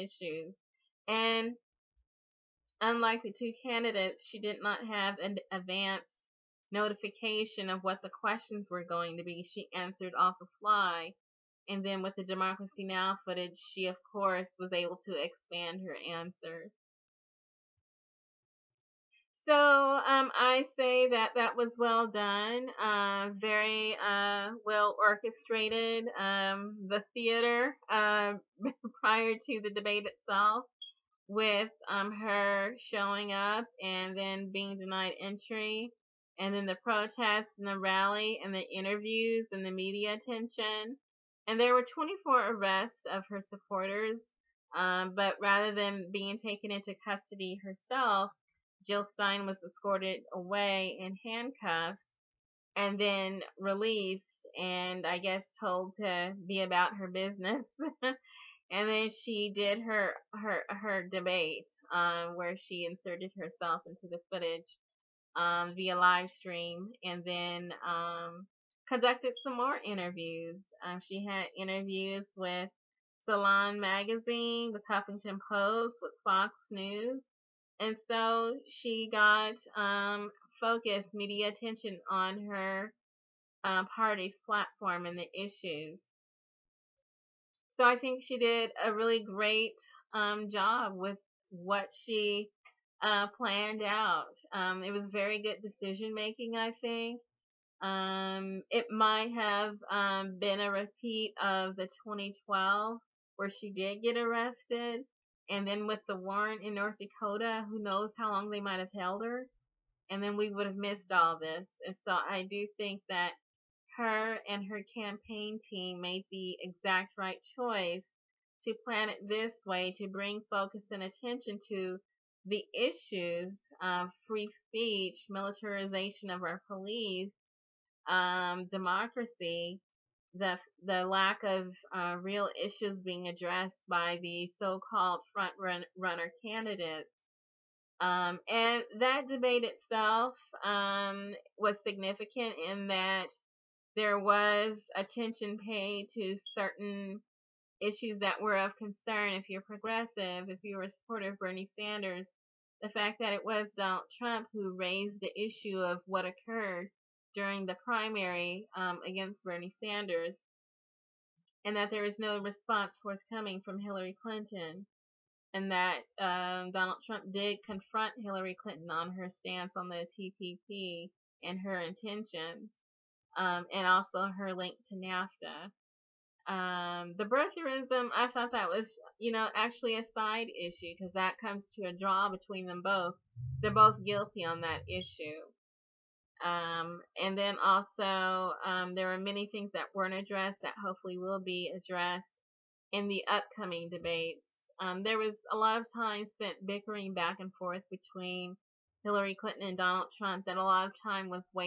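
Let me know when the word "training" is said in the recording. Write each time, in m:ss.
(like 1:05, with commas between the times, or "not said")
not said.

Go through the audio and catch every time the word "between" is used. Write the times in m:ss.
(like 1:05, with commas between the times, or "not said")
3:02, 3:17.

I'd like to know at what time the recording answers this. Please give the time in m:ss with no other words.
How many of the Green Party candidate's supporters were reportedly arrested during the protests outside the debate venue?
0:41.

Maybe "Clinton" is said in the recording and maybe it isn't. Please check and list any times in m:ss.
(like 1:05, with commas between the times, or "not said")
2:44, 2:48, 3:19.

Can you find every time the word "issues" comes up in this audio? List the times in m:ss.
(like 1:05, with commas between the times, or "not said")
1:25, 2:02, 2:12, 2:27, 2:35, 3:00, 3:04.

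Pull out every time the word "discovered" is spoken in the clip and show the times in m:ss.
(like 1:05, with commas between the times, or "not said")
not said.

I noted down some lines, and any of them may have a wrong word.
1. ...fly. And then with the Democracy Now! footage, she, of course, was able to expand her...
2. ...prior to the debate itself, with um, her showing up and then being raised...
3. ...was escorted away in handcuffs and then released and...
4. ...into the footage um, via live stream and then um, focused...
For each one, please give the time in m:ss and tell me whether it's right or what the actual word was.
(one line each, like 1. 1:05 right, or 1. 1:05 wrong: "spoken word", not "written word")
1. 0:10 right
2. 0:29 wrong: "denied", not "raised"
3. 0:49 right
4. 1:03 wrong: "conducted", not "focused".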